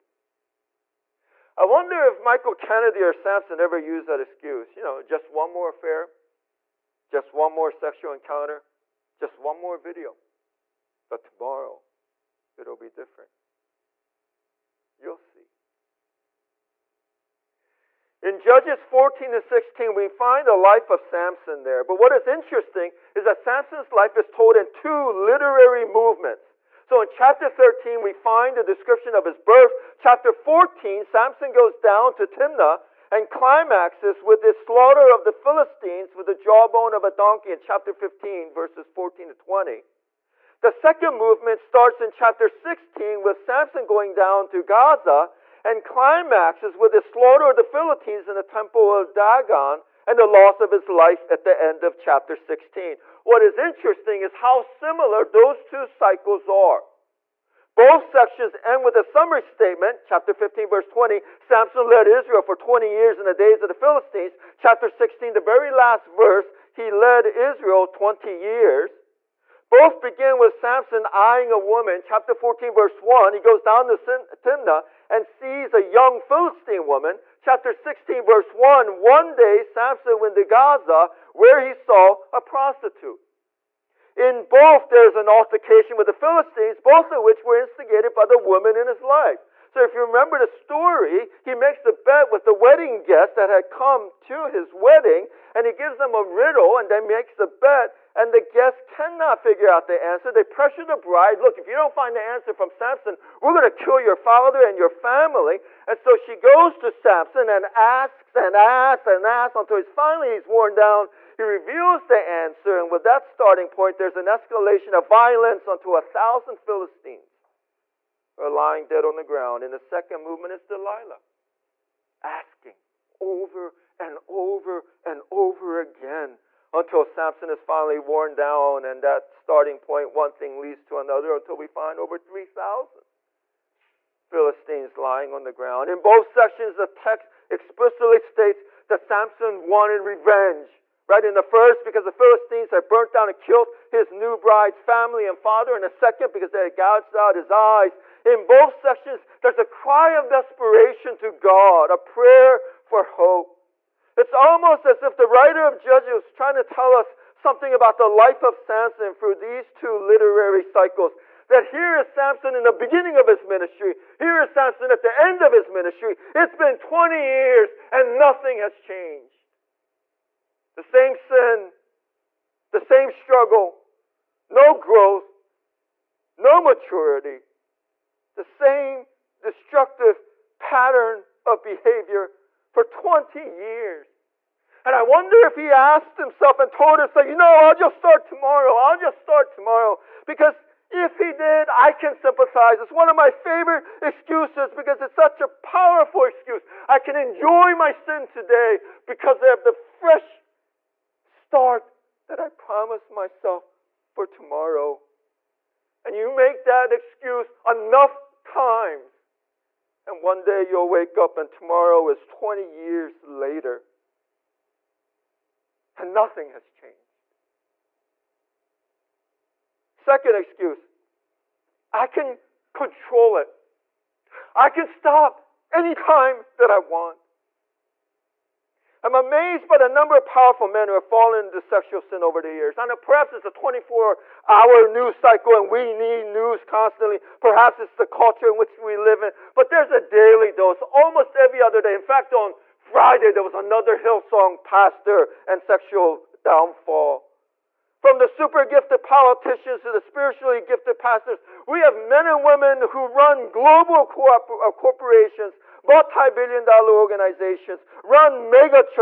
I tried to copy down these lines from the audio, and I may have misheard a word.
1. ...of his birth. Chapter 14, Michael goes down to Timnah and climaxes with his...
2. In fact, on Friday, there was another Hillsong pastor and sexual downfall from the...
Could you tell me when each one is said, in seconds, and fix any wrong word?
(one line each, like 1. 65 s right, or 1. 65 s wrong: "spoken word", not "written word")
1. 29 s wrong: "Samson", not "Michael"
2. 241 s right.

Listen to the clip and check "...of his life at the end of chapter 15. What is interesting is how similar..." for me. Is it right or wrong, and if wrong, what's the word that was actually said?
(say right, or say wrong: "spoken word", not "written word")
wrong: "16", not "15".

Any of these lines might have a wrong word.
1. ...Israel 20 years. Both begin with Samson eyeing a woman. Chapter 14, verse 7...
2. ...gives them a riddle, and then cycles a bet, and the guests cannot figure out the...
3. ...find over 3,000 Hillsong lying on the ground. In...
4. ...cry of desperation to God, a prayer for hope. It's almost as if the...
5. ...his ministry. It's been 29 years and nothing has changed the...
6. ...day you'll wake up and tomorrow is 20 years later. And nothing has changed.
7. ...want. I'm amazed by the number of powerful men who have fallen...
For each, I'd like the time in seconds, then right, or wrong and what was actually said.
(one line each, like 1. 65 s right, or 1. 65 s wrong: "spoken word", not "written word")
1. 67 s wrong: "1", not "7"
2. 95 s wrong: "makes", not "cycles"
3. 131 s wrong: "Philistines", not "Hillsong"
4. 149 s right
5. 165 s wrong: "20", not "29"
6. 210 s right
7. 226 s right.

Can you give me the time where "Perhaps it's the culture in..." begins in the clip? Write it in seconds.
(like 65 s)
237 s.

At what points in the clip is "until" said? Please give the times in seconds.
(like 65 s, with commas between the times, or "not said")
109 s, 126 s, 131 s.